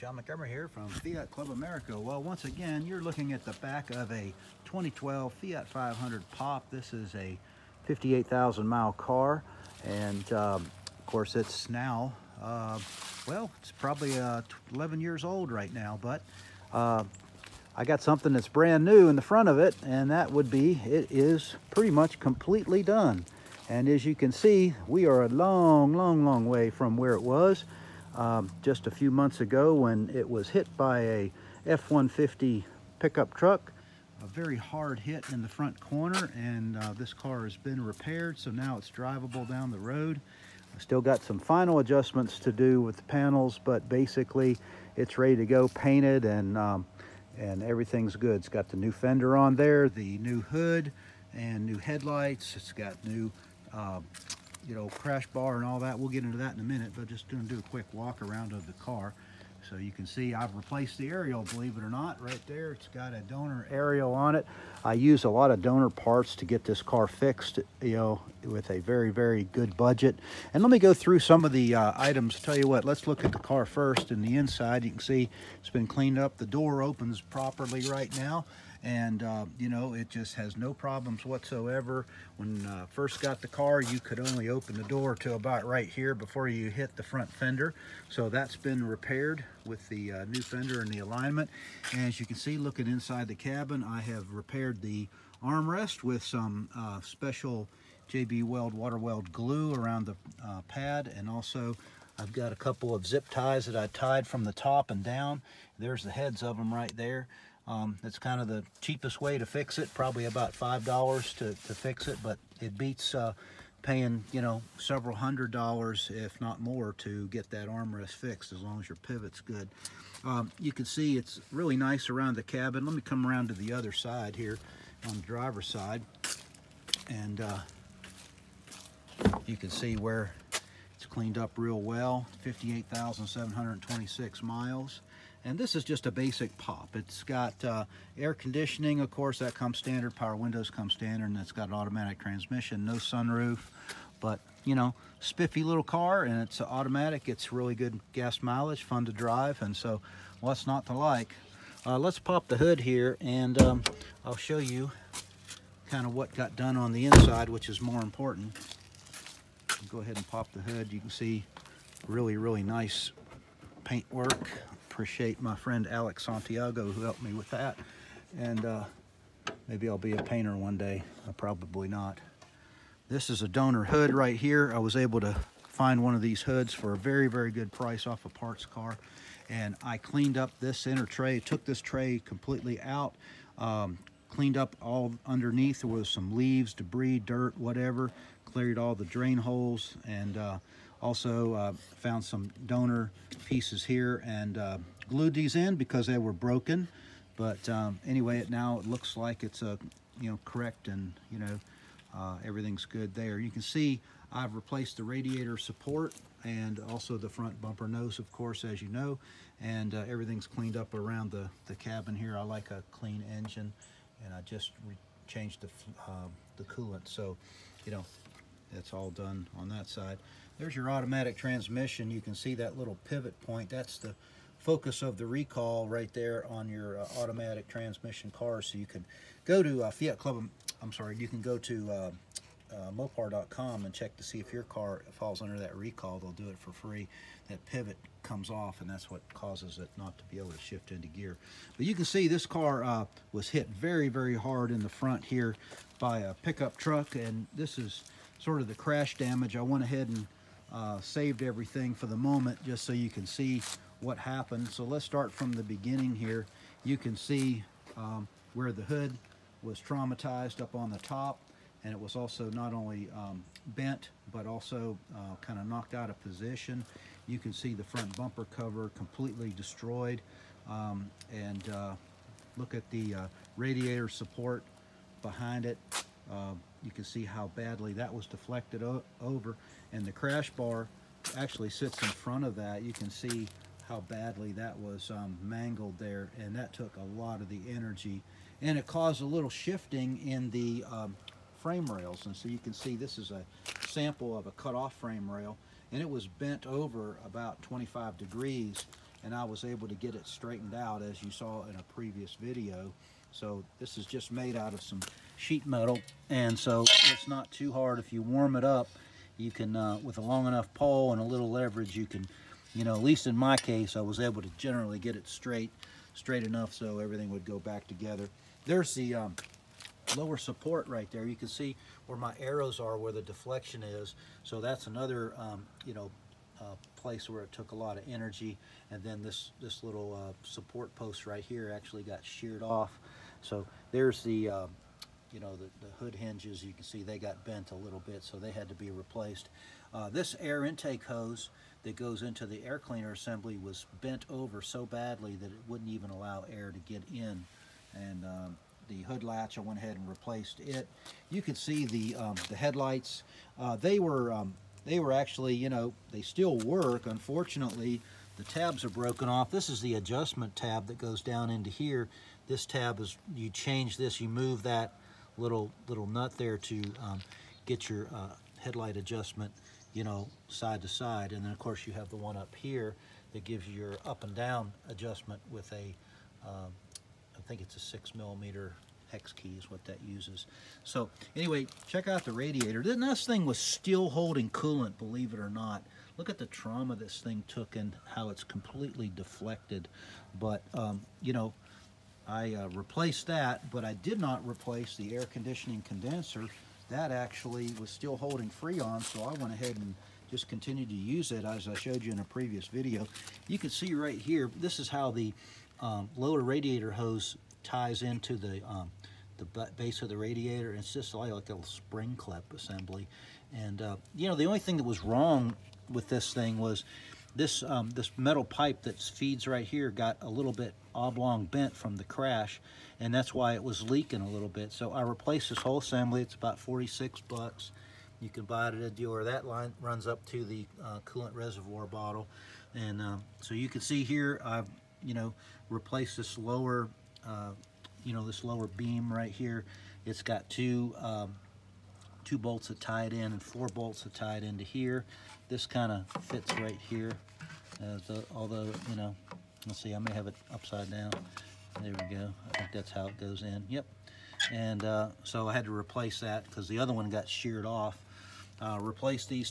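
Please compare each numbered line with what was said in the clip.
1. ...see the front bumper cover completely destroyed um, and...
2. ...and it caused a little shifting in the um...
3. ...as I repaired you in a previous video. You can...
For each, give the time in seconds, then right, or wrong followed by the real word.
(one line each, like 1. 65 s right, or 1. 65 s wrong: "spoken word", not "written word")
1. 267 s right
2. 288 s right
3. 401 s wrong: "showed", not "repaired".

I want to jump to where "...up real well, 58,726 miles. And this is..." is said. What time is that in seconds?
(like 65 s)
131 s.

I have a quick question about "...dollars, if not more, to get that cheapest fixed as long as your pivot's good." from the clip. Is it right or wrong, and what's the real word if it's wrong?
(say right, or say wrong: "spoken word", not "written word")
wrong: "armrest", not "cheapest".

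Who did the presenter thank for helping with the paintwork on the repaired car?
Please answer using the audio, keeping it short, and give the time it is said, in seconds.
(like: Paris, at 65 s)
Alex Santiago, at 165 s.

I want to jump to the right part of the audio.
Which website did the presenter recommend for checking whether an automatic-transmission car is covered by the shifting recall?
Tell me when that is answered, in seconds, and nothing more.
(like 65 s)
232 s.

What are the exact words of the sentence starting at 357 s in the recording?
Unfortunately, the tabs are broken off.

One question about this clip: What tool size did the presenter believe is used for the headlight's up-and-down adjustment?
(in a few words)
6 millimeter hex key.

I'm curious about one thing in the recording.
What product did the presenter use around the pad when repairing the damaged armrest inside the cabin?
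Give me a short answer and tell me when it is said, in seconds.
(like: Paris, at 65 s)
JB Weld water weld, at 98 s.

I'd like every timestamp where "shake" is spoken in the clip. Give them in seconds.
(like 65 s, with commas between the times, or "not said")
not said.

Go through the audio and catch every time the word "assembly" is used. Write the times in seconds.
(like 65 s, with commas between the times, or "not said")
343 s, 412 s, 425 s.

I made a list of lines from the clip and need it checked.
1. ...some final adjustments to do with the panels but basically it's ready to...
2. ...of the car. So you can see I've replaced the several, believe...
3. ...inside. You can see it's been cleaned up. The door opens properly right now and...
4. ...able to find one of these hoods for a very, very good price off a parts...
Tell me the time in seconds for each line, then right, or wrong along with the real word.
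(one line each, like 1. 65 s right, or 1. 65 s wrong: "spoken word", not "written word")
1. 41 s right
2. 58 s wrong: "aerial", not "several"
3. 74 s right
4. 174 s right.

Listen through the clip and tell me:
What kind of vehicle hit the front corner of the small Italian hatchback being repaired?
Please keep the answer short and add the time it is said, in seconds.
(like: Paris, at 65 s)
F-150 pickup truck, at 31 s.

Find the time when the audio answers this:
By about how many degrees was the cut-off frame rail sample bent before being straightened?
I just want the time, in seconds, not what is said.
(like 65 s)
297 s.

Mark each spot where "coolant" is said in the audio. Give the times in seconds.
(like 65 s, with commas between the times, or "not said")
216 s, 384 s, 431 s.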